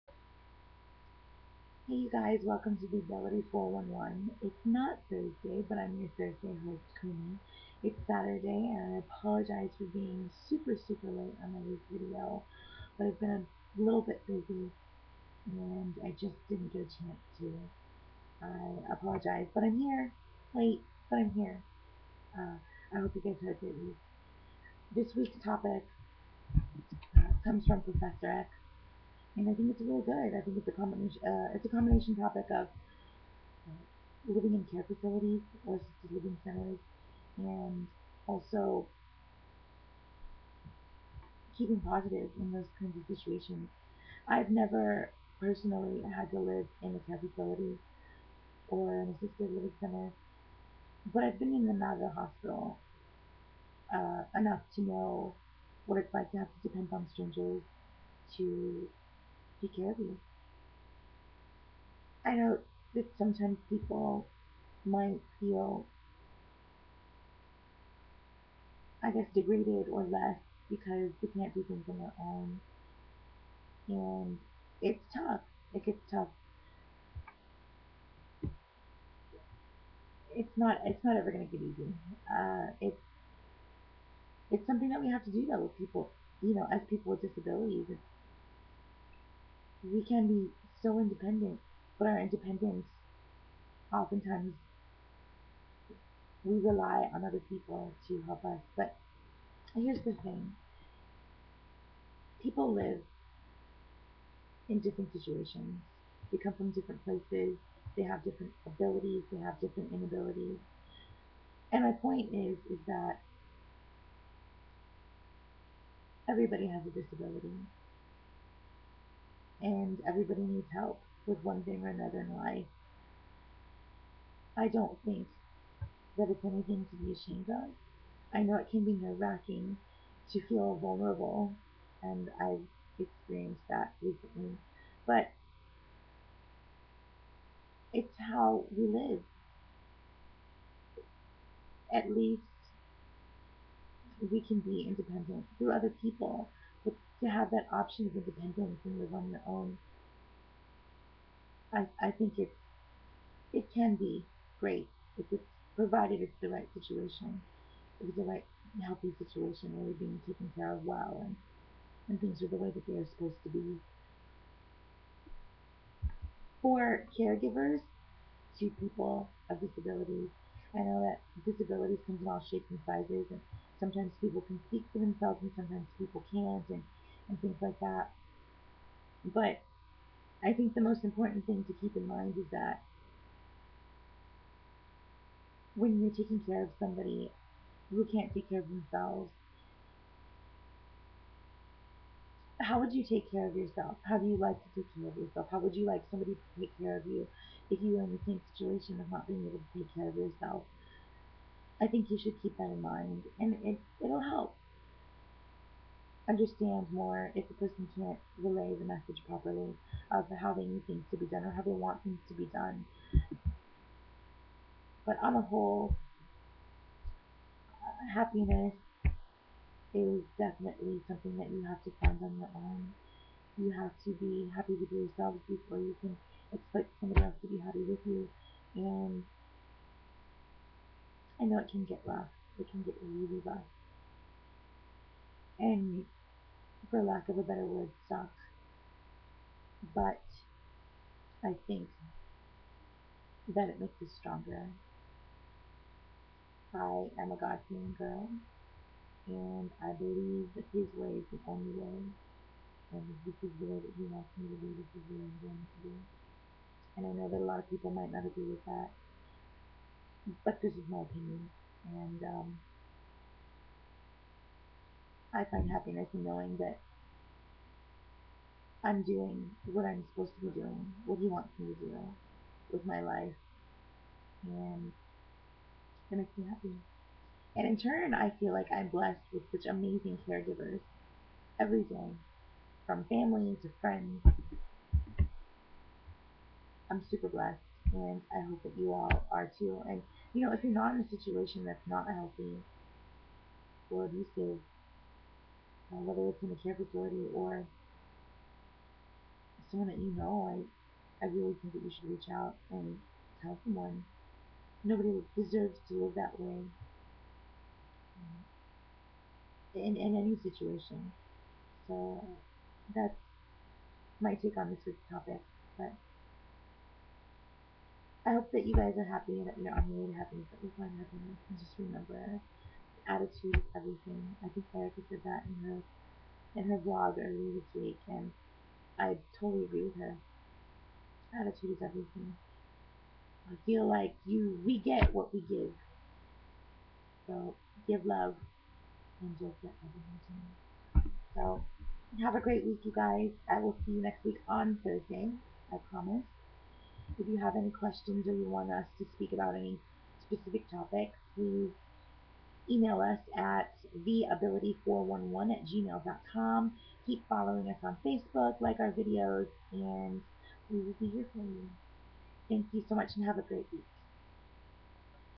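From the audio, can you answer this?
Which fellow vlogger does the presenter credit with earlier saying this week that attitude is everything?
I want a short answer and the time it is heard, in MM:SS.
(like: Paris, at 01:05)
Erica, at 05:24.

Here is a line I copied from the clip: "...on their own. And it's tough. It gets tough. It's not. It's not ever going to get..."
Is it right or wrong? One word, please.
right.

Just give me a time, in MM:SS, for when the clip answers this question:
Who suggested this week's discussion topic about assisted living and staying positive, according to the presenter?
00:27.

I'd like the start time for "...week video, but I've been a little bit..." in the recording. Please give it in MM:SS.
00:11.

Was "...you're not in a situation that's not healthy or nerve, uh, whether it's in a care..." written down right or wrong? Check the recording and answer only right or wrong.
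wrong.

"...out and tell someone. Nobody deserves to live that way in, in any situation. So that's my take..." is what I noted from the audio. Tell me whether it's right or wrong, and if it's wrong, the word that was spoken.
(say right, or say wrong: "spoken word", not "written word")
right.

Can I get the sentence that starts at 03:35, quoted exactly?
But on the whole, uh, happiness is definitely something that you have to find on your own.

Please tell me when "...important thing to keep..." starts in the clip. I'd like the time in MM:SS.
03:01.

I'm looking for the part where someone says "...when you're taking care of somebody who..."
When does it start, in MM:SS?
03:05.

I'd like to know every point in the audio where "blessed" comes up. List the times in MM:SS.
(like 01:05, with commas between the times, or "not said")
04:38, 04:47.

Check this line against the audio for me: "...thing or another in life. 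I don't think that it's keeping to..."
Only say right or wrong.
wrong.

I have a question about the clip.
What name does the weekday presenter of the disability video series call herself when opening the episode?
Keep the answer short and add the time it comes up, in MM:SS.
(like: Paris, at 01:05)
Kumi, at 00:07.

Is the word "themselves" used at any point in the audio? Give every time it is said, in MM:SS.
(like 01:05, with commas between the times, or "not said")
02:54, 03:08.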